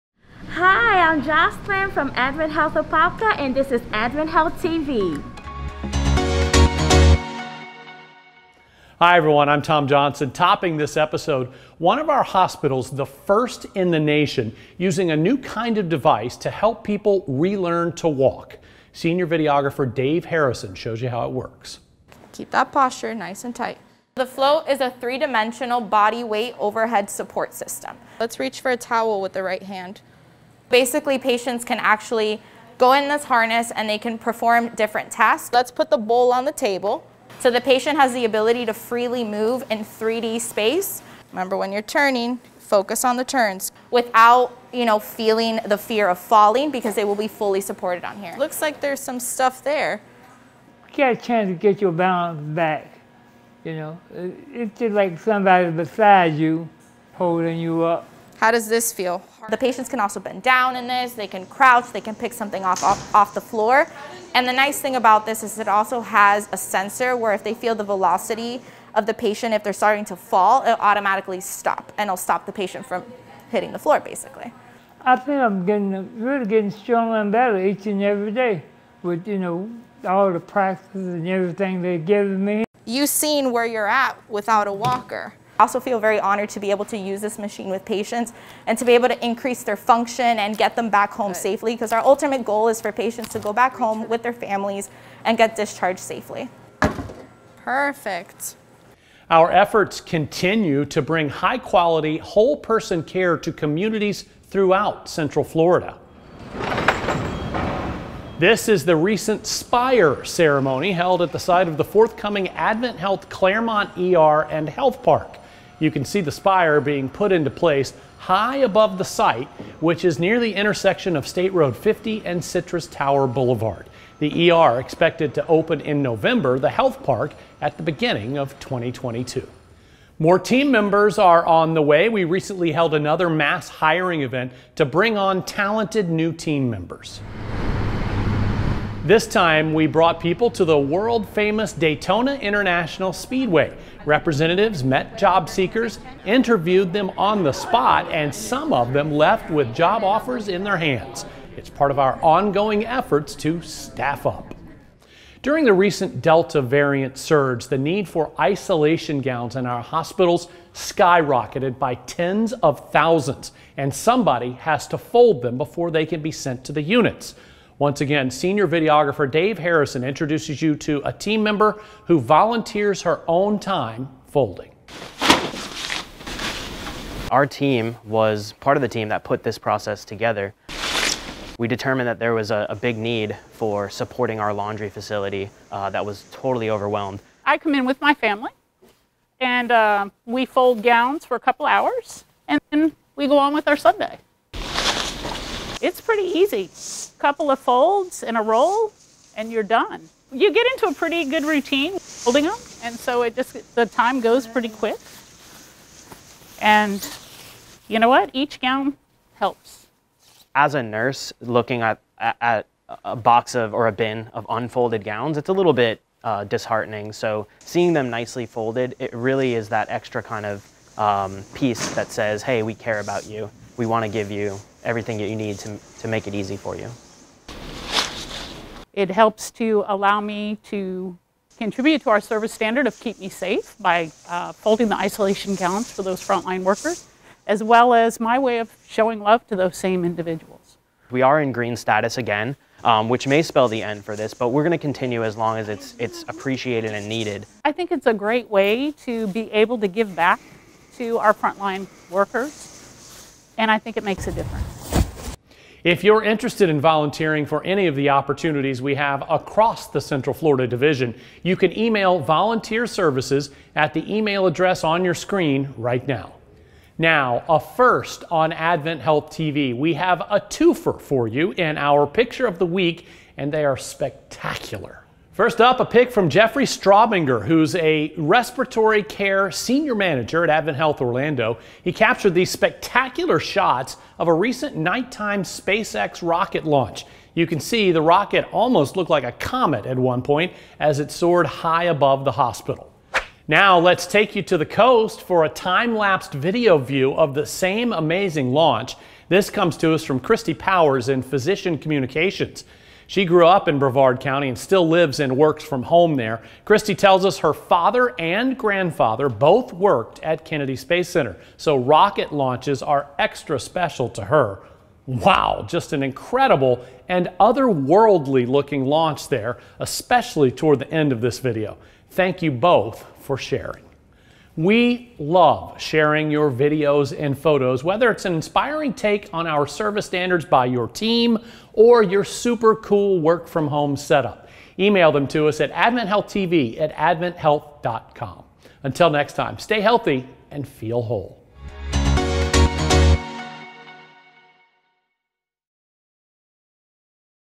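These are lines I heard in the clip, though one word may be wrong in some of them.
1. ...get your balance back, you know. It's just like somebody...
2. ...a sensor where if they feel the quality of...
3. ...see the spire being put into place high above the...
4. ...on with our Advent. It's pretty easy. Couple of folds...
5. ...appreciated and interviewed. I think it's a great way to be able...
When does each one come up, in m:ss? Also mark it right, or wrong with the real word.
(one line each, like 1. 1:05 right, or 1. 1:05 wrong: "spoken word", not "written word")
1. 0:51 right
2. 1:06 wrong: "velocity", not "quality"
3. 1:56 right
4. 3:13 wrong: "Sunday", not "Advent"
5. 4:06 wrong: "needed", not "interviewed".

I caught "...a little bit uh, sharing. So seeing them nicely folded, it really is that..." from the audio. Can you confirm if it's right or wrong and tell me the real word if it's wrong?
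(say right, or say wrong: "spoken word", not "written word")
wrong: "disheartening", not "sharing".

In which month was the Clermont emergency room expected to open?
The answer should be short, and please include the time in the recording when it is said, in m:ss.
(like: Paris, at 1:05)
November, at 2:06.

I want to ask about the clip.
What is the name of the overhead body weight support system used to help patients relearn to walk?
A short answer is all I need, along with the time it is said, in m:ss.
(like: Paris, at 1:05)
The Float, at 0:24.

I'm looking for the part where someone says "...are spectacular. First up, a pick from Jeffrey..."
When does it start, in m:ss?
4:33.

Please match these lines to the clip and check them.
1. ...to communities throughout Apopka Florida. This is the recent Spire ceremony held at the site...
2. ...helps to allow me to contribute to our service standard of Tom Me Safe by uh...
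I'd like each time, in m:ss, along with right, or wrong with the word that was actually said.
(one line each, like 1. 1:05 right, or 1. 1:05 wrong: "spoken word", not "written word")
1. 1:43 wrong: "Central", not "Apopka"
2. 3:49 wrong: "Keep", not "Tom".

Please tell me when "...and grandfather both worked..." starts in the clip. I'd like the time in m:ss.
5:08.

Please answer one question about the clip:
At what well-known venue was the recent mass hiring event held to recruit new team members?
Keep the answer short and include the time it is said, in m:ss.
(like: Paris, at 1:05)
Daytona International Speedway, at 2:21.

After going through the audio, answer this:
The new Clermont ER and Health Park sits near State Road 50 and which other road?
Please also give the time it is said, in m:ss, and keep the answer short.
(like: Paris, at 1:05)
Citrus Tower Boulevard, at 2:02.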